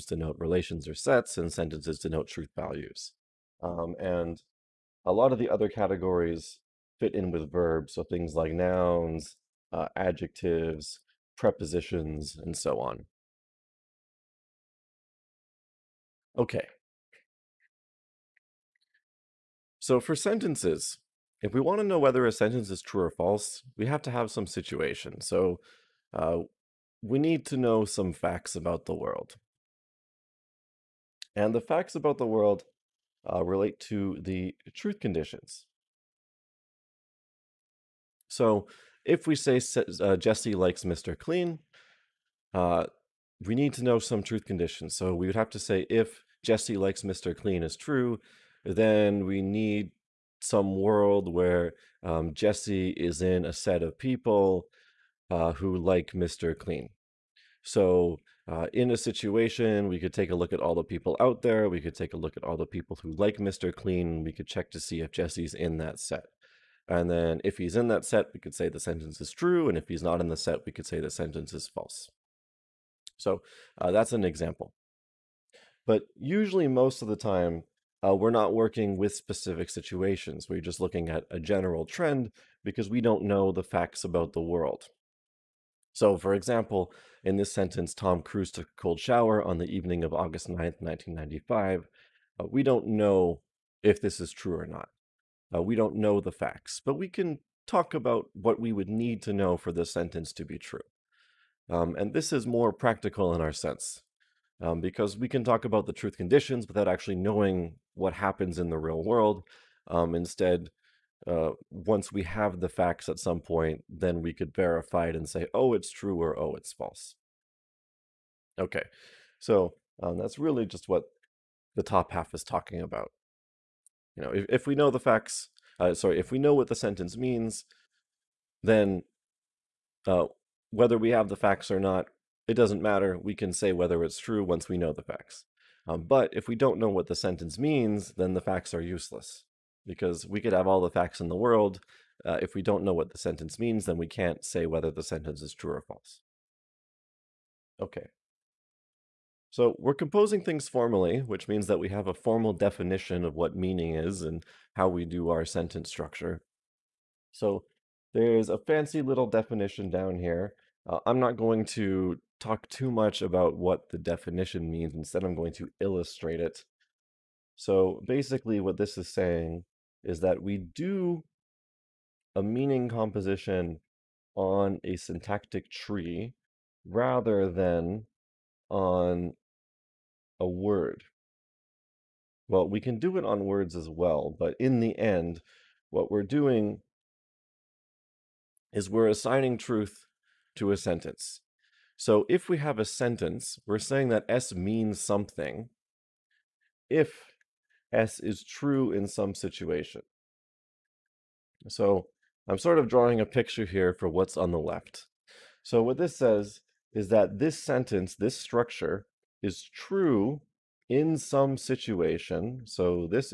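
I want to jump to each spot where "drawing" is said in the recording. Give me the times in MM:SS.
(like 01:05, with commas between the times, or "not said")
03:22.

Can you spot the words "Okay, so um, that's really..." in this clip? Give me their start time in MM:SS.
01:58.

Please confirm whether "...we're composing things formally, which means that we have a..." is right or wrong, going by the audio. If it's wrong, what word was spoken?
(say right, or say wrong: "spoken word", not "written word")
right.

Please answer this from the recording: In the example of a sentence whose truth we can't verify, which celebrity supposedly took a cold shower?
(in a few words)
Tom Cruise.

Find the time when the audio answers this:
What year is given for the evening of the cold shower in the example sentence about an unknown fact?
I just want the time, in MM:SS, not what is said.
01:30.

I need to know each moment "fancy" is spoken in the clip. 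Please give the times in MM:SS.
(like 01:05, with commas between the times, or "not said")
02:38.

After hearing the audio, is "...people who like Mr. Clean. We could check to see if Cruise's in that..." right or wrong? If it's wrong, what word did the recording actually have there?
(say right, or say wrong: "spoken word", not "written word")
wrong: "Jesse", not "Cruise".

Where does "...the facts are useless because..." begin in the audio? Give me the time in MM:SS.
02:18.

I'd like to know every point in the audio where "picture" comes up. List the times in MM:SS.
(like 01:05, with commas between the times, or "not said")
03:23.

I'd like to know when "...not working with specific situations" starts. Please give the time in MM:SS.
01:18.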